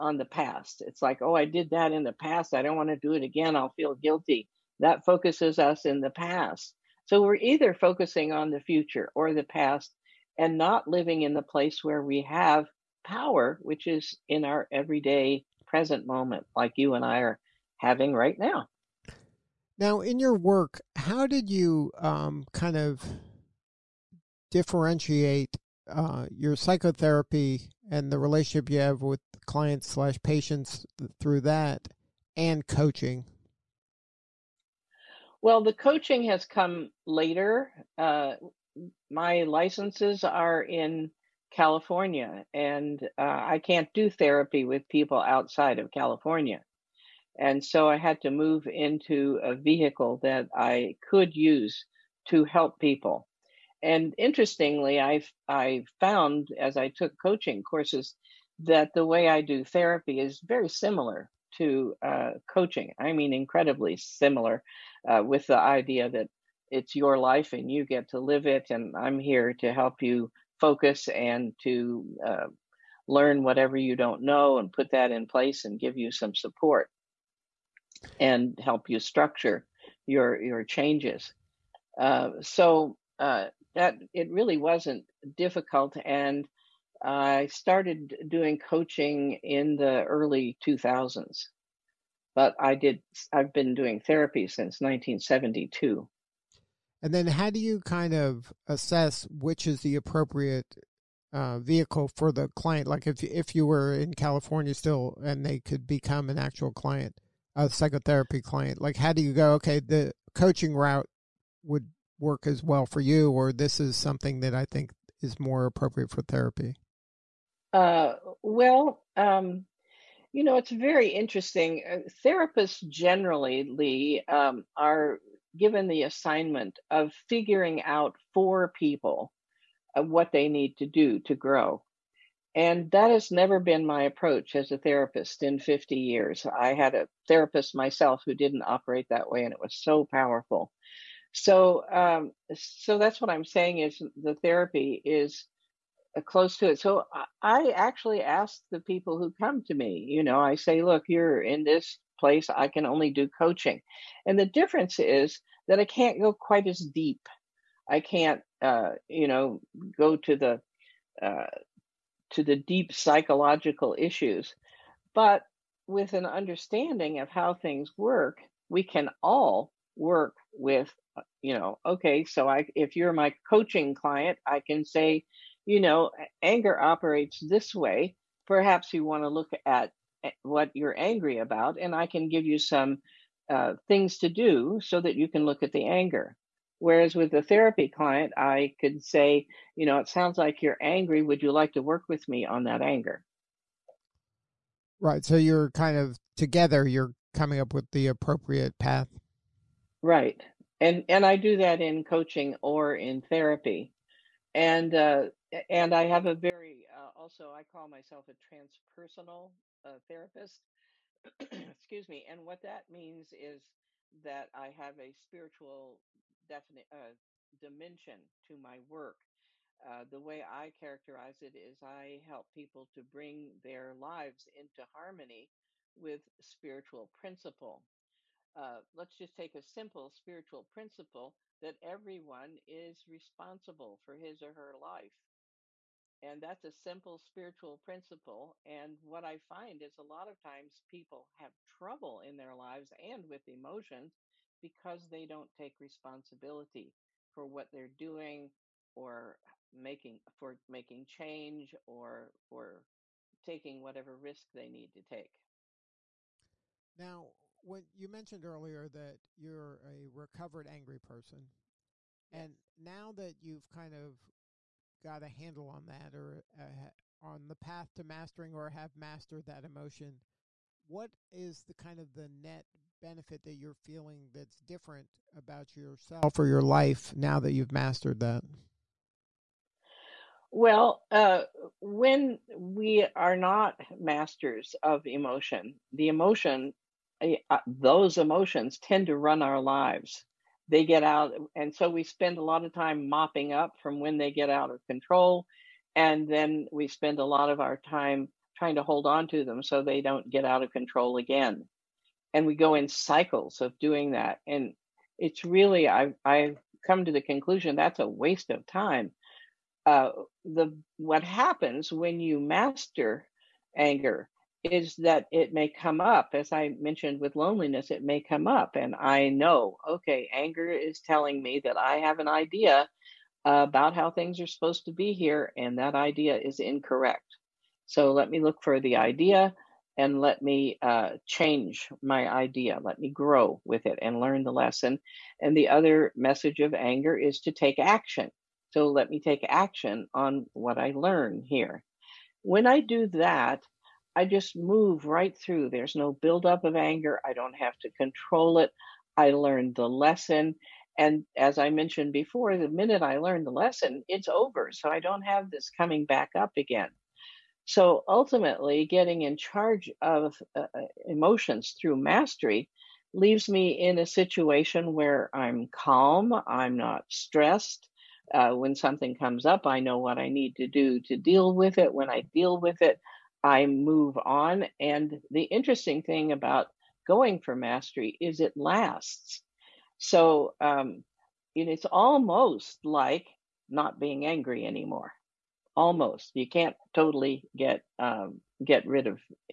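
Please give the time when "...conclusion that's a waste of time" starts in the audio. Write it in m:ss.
5:07.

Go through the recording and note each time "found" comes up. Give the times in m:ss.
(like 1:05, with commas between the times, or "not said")
0:56.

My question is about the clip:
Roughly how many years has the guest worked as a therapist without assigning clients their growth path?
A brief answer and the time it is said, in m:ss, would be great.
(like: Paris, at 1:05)
50, at 2:15.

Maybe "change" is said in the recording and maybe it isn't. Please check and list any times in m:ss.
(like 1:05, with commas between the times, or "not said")
1:20, 4:11, 5:31.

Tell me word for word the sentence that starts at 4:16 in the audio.
Now, when you mentioned earlier that you're a recovered angry person, yes.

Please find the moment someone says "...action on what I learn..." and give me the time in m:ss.
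5:39.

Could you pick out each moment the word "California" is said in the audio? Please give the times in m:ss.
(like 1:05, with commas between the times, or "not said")
0:41, 0:45, 1:44.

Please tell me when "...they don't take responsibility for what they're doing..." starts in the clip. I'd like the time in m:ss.
4:05.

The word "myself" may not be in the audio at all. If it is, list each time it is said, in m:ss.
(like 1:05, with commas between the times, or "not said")
2:17, 3:27.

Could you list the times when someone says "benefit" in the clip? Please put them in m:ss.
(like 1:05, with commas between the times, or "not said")
4:33.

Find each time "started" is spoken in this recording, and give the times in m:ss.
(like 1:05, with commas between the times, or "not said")
1:27.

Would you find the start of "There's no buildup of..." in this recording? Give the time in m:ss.
5:45.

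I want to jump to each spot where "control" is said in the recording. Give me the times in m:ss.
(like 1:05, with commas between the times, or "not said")
4:54, 5:00, 5:47.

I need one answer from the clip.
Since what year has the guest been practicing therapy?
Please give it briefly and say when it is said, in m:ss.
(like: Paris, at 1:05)
1972, at 1:34.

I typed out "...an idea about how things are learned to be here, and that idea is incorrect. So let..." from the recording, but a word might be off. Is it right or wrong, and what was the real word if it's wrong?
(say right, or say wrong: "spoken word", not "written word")
wrong: "supposed", not "learned".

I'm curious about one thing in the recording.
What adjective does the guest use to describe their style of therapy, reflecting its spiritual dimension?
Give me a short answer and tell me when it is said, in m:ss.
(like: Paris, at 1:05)
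transpersonal, at 3:28.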